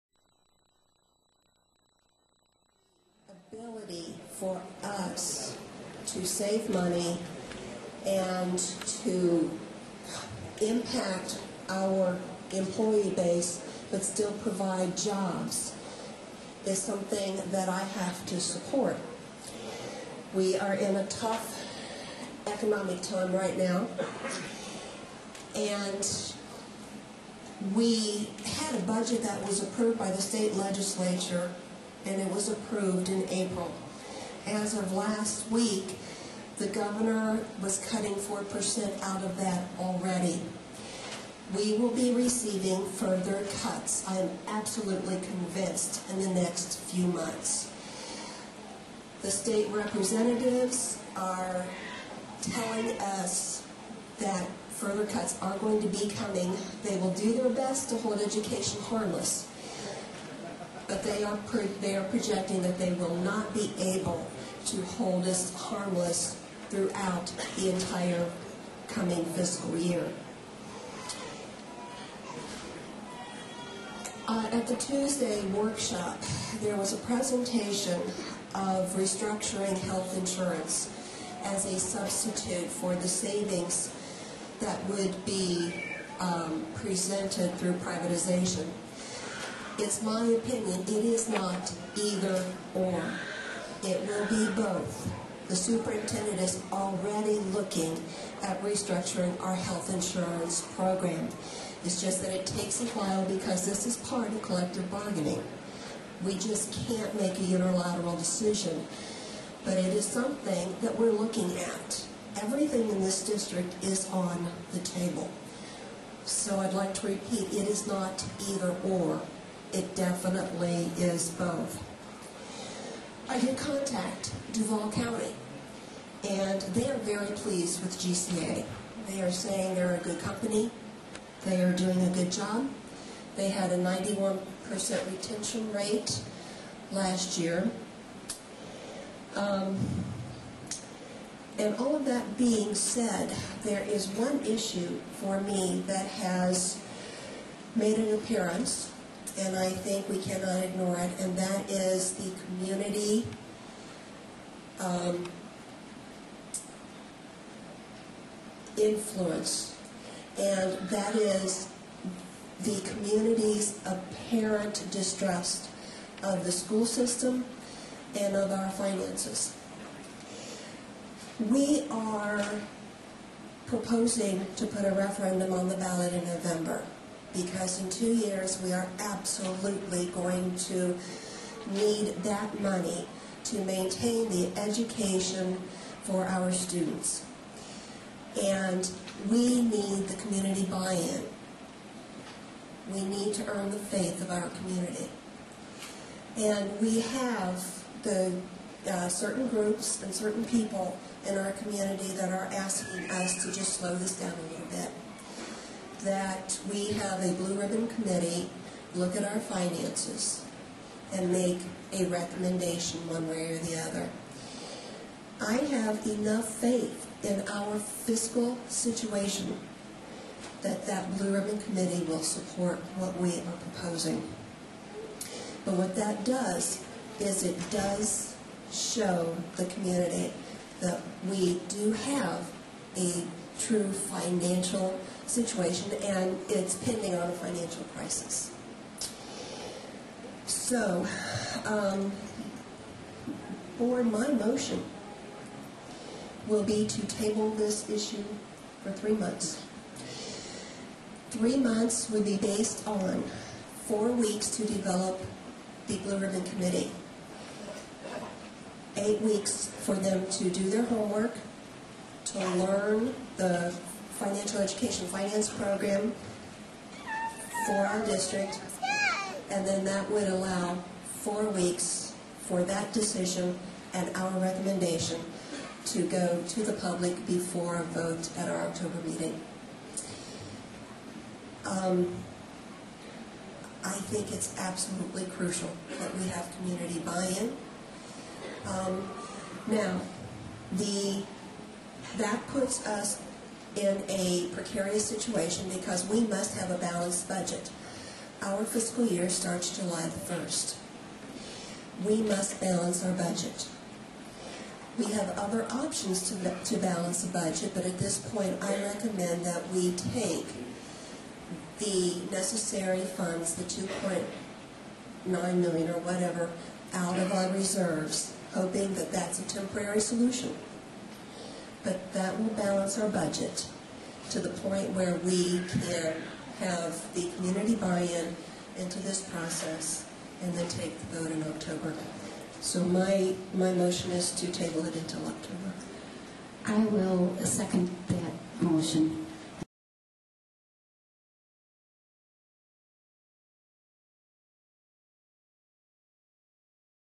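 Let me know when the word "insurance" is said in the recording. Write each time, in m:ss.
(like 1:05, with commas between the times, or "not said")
1:20, 1:39.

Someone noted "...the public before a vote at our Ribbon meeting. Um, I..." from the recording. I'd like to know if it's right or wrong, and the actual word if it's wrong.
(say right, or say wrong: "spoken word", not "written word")
wrong: "October", not "Ribbon".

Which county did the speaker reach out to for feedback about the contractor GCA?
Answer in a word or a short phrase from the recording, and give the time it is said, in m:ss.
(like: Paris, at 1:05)
Duval County, at 2:04.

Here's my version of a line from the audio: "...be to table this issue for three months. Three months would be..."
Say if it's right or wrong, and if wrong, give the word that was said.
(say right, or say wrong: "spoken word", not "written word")
right.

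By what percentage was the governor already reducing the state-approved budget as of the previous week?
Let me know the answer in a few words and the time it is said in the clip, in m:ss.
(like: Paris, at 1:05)
4%, at 0:38.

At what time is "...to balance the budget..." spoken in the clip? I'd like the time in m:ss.
5:06.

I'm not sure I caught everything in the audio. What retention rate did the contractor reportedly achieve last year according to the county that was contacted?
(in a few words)
91%.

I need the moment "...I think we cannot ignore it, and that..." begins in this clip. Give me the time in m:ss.
2:29.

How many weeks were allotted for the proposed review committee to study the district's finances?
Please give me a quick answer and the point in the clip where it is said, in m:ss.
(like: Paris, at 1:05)
8, at 4:18.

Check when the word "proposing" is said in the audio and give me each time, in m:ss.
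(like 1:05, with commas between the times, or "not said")
2:53, 3:43.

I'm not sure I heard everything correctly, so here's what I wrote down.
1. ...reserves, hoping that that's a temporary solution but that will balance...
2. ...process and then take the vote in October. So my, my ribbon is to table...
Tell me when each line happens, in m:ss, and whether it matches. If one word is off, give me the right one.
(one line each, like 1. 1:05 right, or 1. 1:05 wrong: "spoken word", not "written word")
1. 5:17 right
2. 5:29 wrong: "motion", not "ribbon".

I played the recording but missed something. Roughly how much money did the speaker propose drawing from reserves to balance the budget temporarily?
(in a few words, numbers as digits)
2.9 million.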